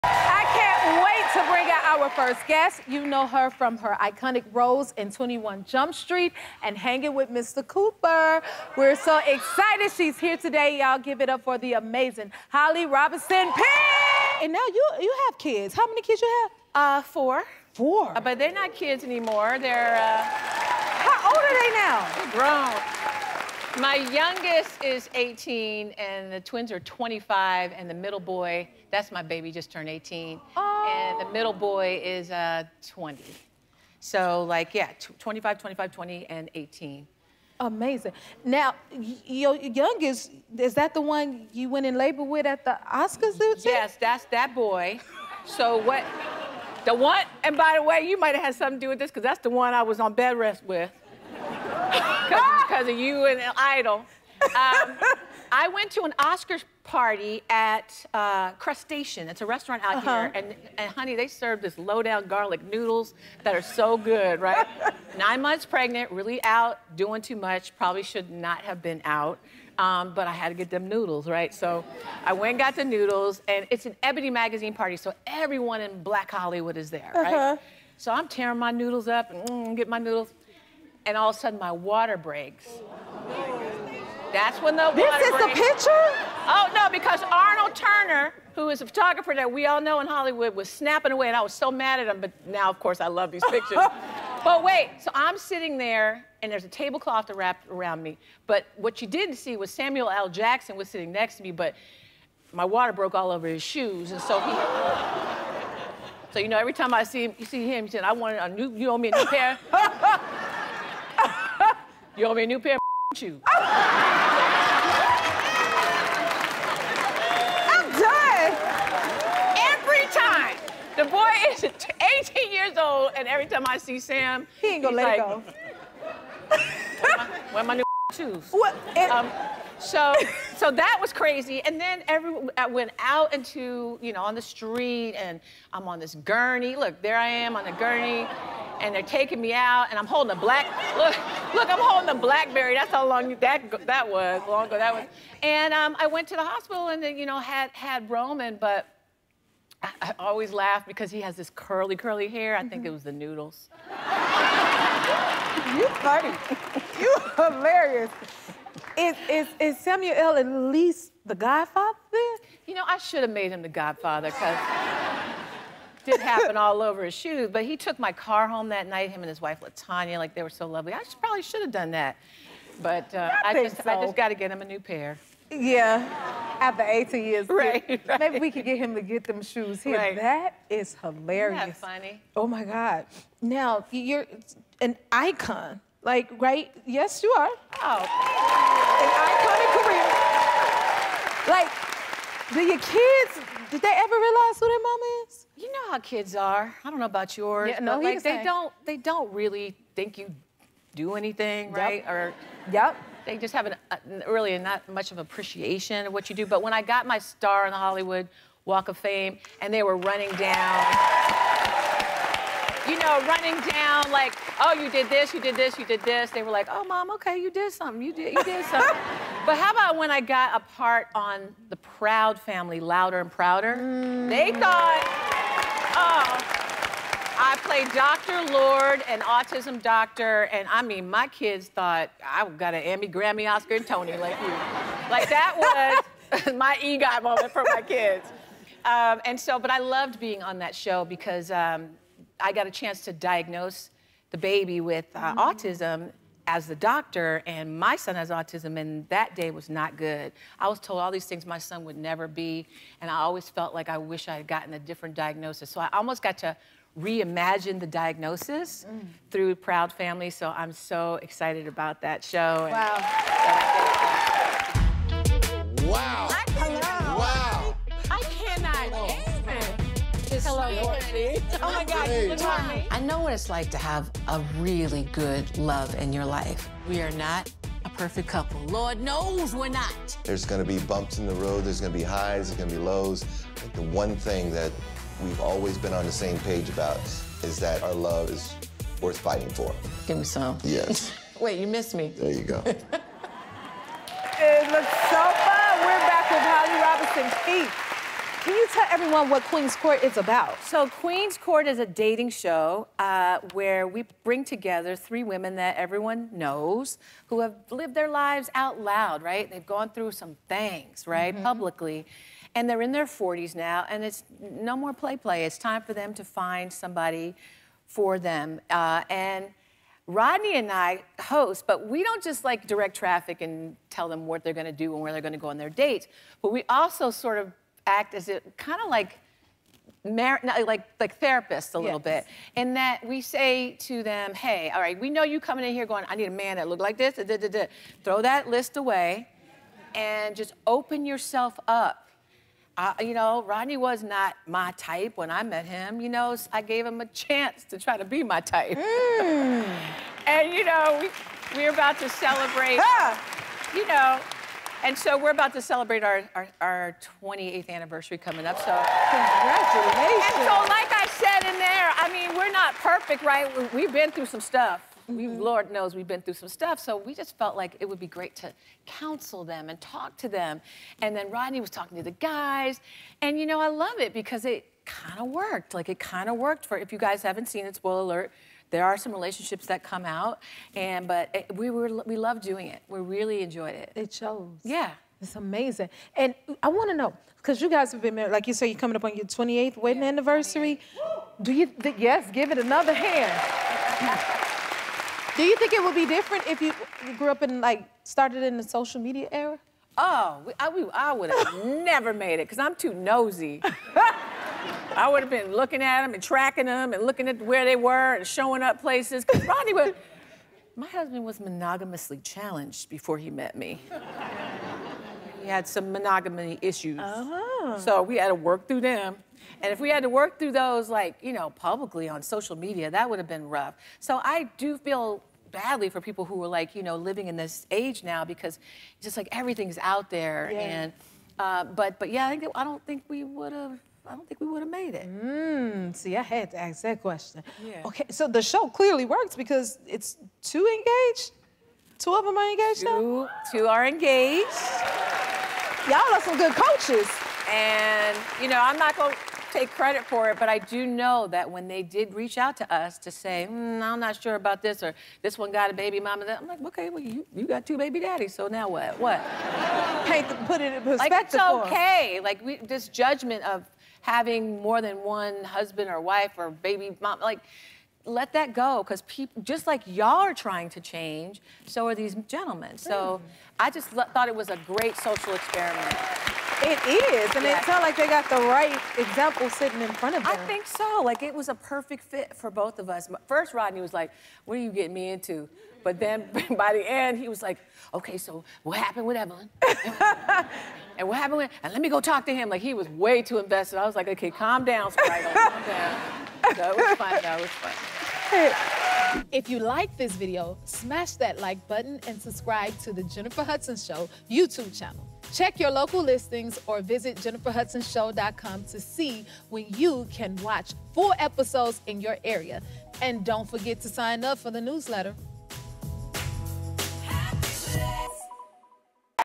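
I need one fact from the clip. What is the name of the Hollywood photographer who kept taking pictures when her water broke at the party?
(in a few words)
Arnold Turner.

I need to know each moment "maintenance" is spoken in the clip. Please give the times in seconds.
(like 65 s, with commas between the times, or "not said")
not said.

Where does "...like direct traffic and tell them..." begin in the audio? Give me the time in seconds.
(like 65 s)
322 s.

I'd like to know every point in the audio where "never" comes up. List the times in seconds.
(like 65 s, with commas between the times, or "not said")
251 s, 401 s.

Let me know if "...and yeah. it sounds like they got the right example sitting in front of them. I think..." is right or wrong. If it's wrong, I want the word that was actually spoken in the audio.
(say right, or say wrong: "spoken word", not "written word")
right.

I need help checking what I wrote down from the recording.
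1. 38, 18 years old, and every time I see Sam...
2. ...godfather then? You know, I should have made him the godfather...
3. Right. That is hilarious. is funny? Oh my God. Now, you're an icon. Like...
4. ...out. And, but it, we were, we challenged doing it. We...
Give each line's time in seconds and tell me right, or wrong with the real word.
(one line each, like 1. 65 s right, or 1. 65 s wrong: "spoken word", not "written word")
1. 121 s wrong: "18", not "38"
2. 161 s right
3. 179 s right
4. 380 s wrong: "loved", not "challenged".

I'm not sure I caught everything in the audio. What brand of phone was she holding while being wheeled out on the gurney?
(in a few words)
BlackBerry.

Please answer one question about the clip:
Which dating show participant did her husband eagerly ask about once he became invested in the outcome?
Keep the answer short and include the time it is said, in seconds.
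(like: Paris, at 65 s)
Evelyn, at 489 s.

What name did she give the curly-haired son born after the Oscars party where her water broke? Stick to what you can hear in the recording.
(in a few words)
Roman.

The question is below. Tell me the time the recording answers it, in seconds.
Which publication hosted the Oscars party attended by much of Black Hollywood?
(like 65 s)
74 s.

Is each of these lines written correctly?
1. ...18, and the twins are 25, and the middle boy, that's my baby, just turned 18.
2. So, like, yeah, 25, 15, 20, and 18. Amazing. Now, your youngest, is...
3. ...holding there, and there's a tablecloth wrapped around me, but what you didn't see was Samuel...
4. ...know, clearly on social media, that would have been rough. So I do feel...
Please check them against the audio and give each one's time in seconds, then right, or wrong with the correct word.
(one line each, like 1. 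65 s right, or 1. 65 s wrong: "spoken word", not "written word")
1. 25 s right
2. 33 s wrong: "25", not "15"
3. 95 s wrong: "sitting", not "holding"
4. 421 s wrong: "publicly", not "clearly".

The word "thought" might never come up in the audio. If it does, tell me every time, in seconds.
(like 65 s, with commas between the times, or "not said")
224 s, 231 s, 473 s.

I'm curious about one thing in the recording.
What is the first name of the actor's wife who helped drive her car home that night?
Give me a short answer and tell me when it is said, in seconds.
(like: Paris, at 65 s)
LaTanya, at 169 s.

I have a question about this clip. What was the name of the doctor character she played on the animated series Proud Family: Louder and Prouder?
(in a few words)
Dr. Lord.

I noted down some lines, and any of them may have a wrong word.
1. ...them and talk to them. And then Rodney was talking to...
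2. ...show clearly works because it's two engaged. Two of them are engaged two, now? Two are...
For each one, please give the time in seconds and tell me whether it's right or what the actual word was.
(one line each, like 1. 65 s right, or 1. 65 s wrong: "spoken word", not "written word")
1. 369 s right
2. 438 s right.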